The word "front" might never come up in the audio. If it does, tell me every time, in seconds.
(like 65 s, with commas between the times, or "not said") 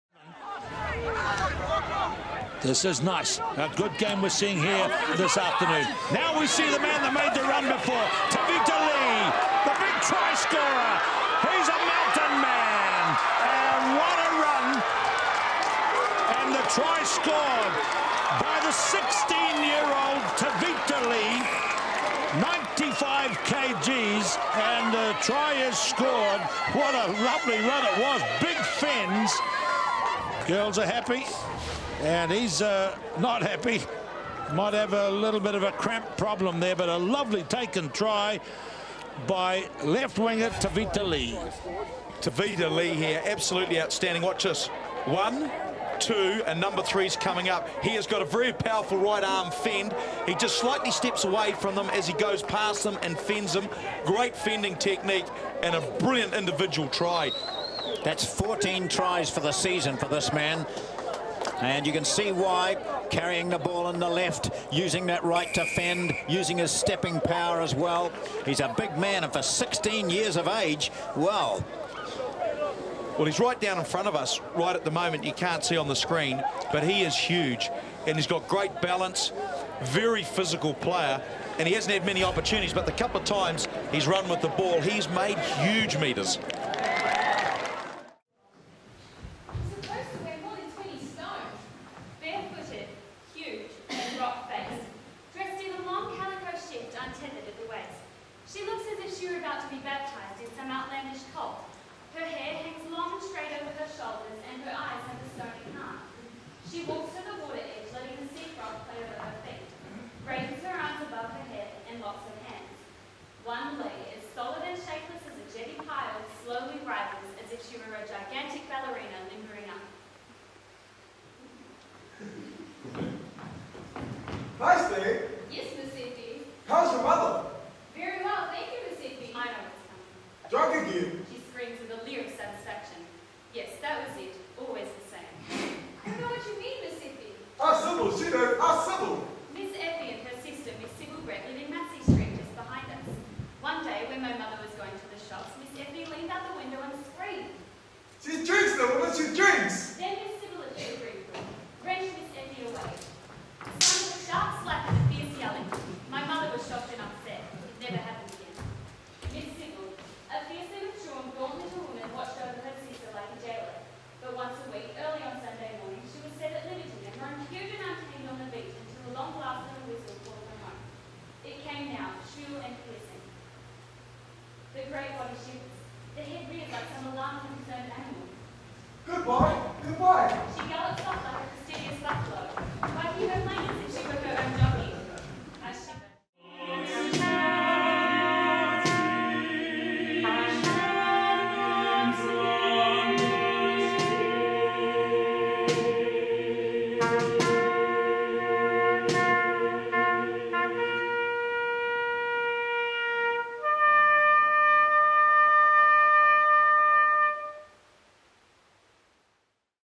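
73 s.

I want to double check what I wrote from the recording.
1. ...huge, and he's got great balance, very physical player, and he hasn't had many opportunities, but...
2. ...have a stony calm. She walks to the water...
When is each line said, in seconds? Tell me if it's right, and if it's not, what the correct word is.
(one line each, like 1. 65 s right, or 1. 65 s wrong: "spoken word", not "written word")
1. 77 s right
2. 104 s right.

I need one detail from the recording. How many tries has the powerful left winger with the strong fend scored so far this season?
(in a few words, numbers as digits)
14.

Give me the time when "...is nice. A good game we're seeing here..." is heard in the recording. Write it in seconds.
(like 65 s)
2 s.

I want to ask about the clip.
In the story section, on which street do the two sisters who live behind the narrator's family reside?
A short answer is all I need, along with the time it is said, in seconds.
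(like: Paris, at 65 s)
Massey Street, at 141 s.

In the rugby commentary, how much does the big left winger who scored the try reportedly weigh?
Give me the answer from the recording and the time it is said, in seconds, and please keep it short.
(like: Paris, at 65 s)
95 kg, at 22 s.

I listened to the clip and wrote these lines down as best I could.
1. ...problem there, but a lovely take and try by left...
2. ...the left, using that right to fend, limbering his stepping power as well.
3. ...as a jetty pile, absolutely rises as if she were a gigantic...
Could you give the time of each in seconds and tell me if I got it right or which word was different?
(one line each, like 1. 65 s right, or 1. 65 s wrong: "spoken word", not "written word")
1. 36 s right
2. 63 s wrong: "using", not "limbering"
3. 115 s wrong: "slowly", not "absolutely".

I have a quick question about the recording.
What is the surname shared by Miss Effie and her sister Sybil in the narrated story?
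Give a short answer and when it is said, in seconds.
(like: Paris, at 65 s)
Brett, at 141 s.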